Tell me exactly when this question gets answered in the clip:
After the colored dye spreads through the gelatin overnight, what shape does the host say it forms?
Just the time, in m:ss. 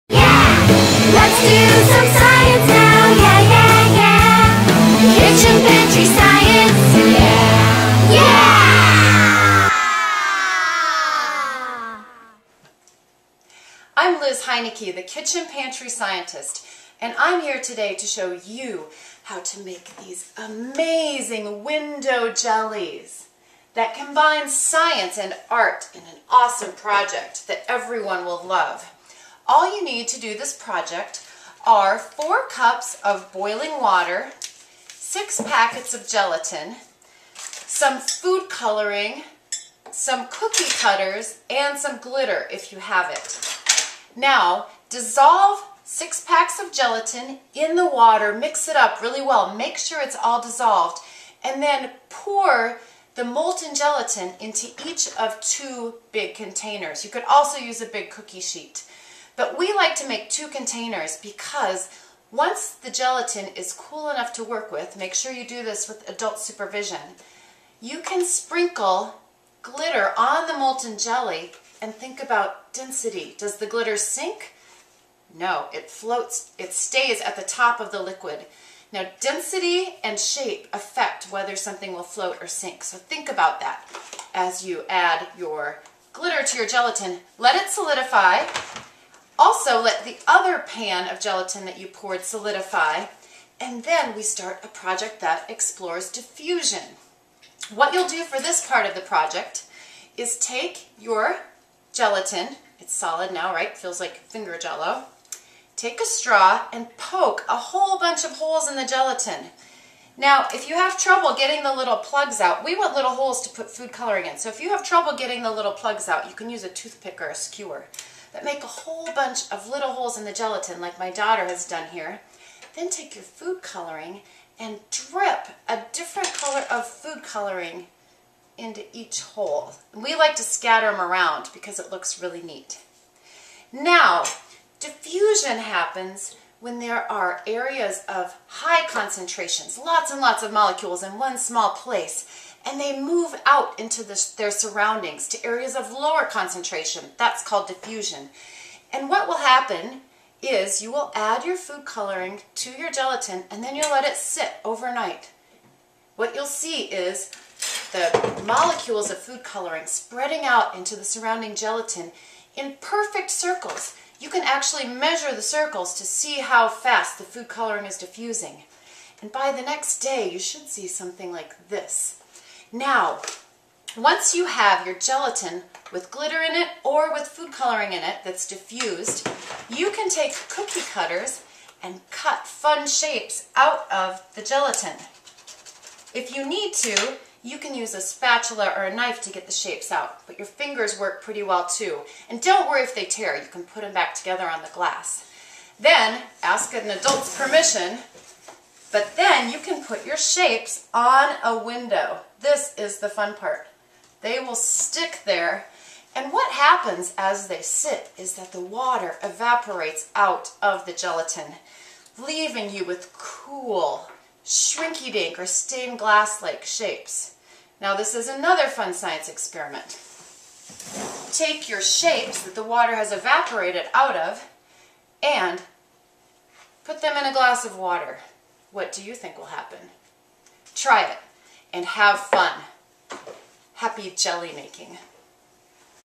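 2:42.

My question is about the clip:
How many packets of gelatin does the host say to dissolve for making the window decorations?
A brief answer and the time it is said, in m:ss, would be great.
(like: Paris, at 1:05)
6, at 0:34.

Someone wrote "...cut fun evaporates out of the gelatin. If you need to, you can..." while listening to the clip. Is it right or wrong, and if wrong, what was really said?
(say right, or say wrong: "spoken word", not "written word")
wrong: "shapes", not "evaporates".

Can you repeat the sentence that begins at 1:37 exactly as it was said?
What you'll do for this part of the project is take your gelatin, it's solid now, right?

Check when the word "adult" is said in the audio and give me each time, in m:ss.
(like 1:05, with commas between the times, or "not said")
1:06, 3:16.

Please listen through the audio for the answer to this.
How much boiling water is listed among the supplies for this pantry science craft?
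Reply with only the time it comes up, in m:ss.
0:31.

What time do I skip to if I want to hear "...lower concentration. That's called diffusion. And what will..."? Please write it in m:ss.
2:25.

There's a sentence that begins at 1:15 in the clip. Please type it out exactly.
No, it floats, it stays at the top of the liquid.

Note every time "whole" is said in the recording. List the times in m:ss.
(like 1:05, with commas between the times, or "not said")
1:47, 1:58.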